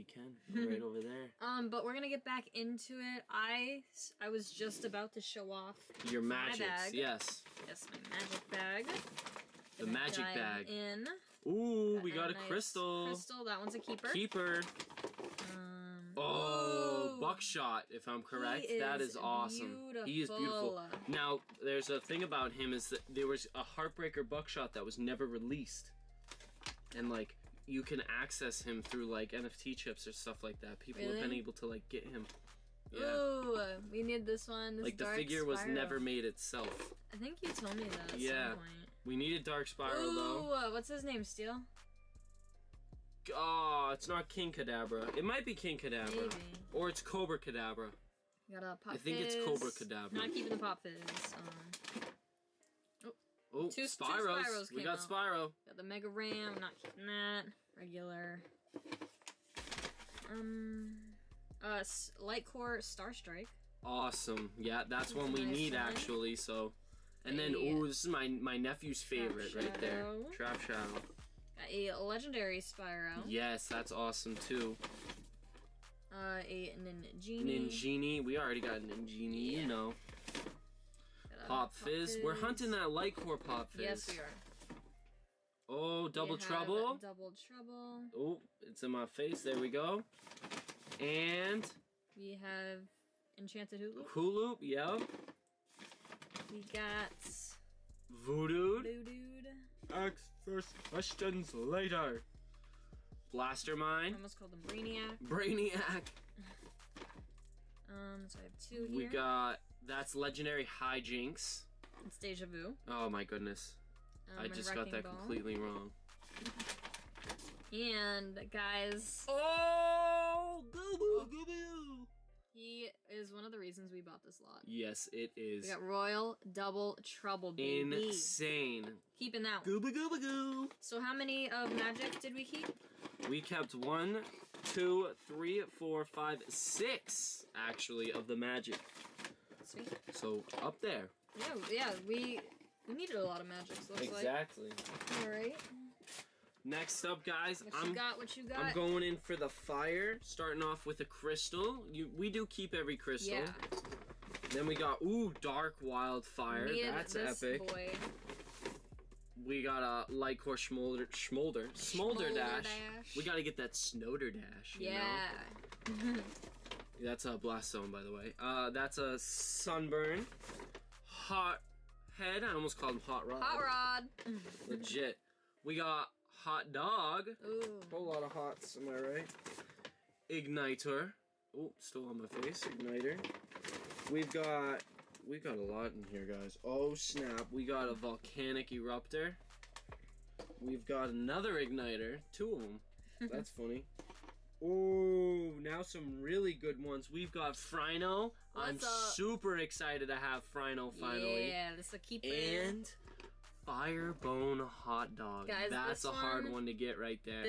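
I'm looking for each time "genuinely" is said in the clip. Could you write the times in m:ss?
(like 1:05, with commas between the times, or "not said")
not said.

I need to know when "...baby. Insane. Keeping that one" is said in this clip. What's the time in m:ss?
2:07.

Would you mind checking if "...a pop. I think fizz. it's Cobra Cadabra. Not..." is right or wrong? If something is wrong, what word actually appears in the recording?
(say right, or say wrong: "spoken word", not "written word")
right.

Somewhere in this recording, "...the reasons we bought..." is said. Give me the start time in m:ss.
2:03.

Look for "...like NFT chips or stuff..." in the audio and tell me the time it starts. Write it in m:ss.
0:29.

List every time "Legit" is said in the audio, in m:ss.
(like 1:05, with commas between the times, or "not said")
2:54.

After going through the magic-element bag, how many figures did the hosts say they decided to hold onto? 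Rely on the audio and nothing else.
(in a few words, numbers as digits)
6.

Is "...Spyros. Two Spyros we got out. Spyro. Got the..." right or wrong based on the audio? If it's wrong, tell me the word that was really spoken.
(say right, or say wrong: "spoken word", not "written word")
right.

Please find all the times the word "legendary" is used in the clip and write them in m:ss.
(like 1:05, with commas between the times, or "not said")
1:11, 1:50.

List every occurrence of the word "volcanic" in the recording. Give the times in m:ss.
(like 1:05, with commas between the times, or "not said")
3:07.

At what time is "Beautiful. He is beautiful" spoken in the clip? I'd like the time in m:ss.
0:19.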